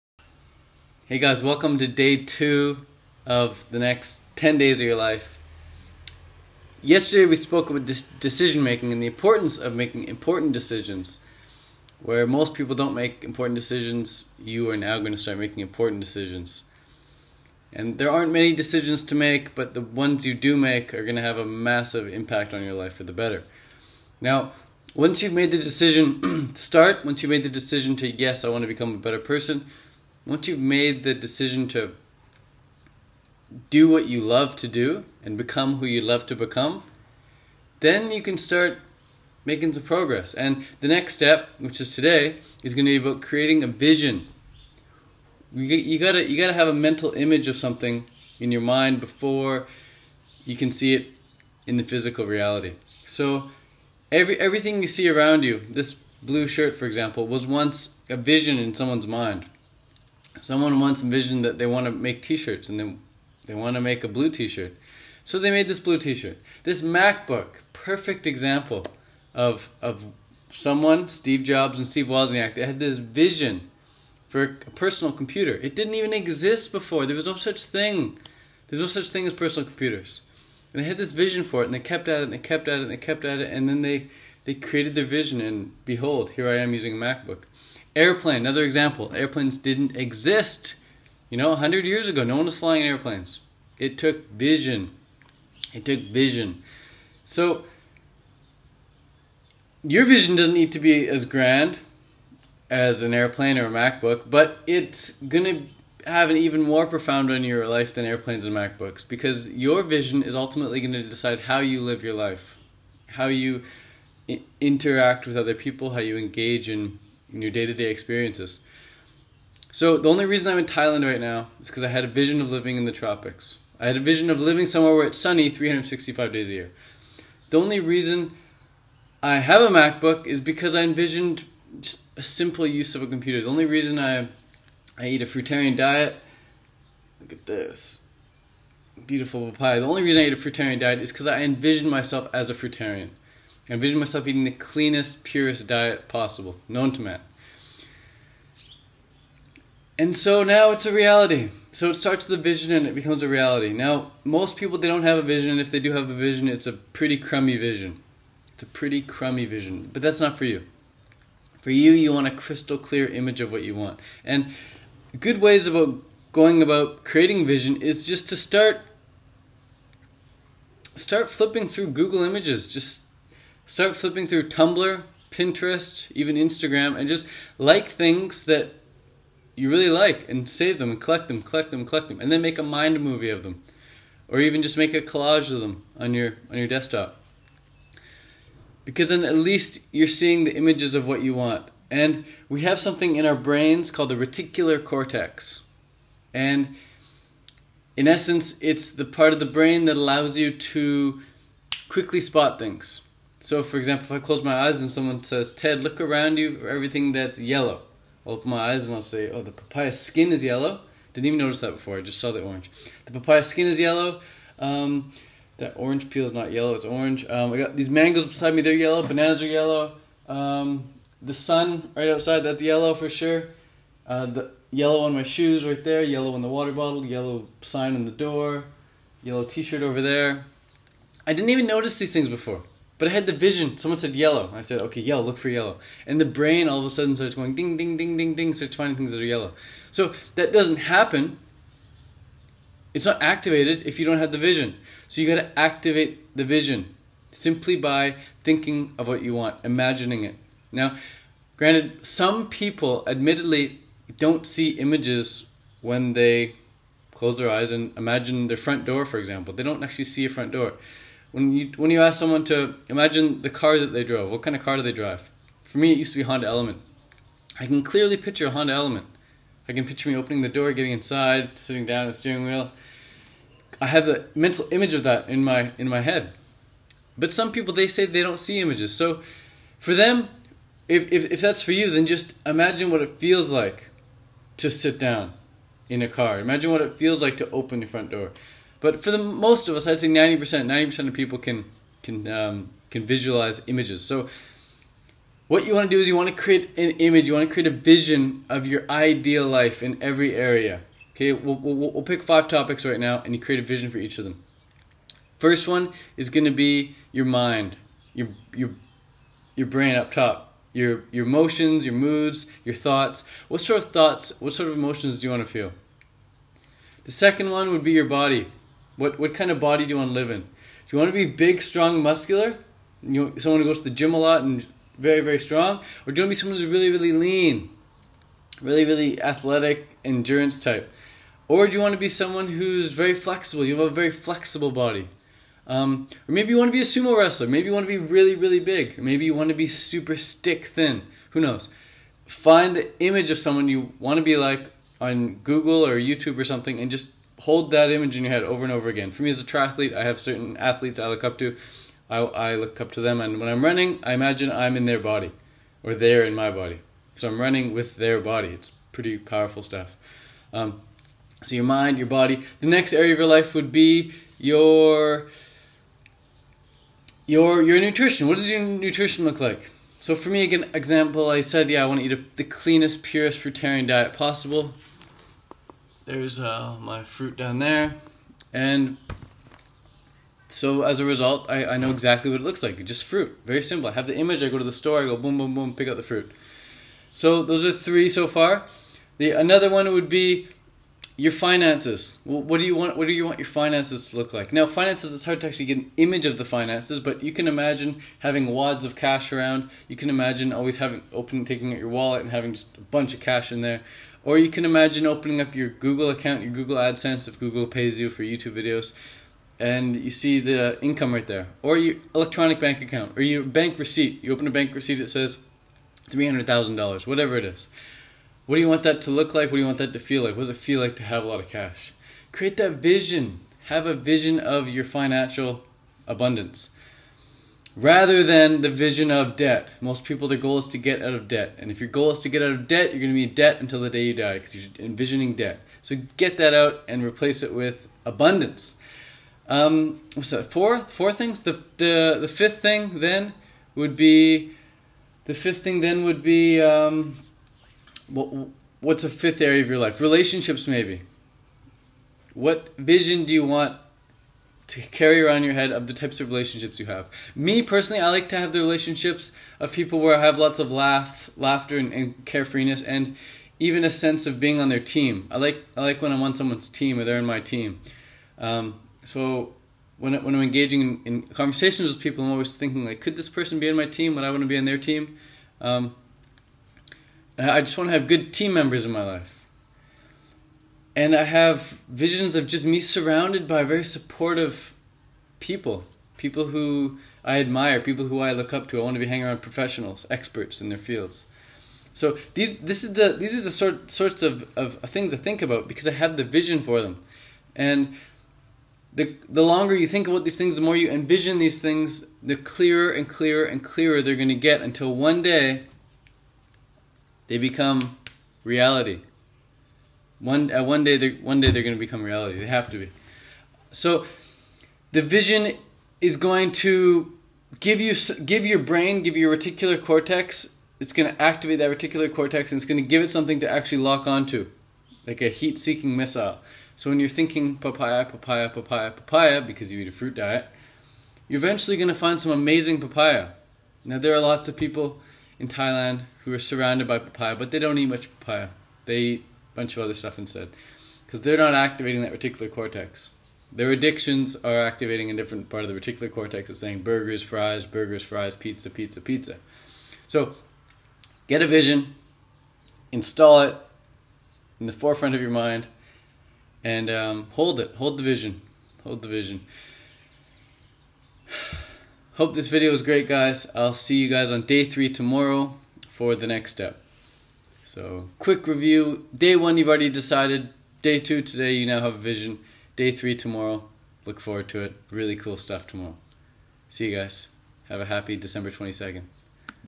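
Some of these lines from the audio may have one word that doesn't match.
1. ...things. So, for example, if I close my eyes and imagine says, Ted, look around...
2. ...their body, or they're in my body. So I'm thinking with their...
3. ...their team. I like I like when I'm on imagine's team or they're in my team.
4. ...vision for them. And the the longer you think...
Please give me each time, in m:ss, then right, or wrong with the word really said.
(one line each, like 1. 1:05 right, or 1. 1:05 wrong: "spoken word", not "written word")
1. 3:22 wrong: "someone", not "imagine"
2. 5:54 wrong: "running", not "thinking"
3. 7:44 wrong: "someone", not "imagine"
4. 8:16 right.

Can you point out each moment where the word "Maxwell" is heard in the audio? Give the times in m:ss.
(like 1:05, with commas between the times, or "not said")
not said.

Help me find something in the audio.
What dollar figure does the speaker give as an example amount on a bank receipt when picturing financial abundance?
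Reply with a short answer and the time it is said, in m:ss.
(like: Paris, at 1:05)
$300,000, at 6:56.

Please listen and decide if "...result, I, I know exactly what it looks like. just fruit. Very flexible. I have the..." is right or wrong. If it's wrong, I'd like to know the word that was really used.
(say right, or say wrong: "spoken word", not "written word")
wrong: "simple", not "flexible".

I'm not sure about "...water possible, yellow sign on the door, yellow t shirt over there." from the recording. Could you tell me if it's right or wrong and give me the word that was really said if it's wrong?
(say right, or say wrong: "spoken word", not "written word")
wrong: "bottle", not "possible".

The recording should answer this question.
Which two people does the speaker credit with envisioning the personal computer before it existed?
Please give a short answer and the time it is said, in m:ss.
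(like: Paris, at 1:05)
Steve Jobs and Steve Wozniak, at 1:11.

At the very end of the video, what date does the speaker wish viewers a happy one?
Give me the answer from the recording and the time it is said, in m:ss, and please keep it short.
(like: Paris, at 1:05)
December 22nd, at 9:38.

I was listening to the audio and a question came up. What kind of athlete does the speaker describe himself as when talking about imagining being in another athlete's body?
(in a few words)
Triathlete.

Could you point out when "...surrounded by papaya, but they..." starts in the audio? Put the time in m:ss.
8:56.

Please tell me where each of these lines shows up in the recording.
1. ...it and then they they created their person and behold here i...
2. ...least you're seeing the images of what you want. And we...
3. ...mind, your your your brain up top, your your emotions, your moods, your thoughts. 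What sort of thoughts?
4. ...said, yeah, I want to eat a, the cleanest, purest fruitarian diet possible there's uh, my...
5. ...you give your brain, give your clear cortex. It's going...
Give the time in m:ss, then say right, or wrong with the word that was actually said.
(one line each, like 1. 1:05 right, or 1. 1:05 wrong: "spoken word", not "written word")
1. 1:23 wrong: "vision", not "person"
2. 3:09 right
3. 5:07 right
4. 6:11 right
5. 8:37 wrong: "reticular", not "clear".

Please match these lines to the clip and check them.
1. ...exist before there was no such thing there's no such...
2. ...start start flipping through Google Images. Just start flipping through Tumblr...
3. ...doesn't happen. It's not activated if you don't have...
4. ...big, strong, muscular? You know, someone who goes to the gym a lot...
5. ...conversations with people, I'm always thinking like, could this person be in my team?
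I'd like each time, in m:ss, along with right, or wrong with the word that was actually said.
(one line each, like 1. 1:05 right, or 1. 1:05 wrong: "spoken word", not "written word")
1. 1:16 right
2. 2:48 right
3. 4:00 right
4. 5:21 right
5. 7:51 right.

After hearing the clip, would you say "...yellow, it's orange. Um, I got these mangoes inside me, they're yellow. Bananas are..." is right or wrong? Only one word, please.
wrong.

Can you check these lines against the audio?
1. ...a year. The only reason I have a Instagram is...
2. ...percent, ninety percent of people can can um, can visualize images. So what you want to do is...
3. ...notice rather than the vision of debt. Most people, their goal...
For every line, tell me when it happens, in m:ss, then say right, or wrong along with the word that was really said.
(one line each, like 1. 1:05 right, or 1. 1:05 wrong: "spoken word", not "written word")
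1. 2:06 wrong: "MacBook", not "Instagram"
2. 4:50 right
3. 7:06 wrong: "abundance", not "notice".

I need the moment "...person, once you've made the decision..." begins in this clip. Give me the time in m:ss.
0:29.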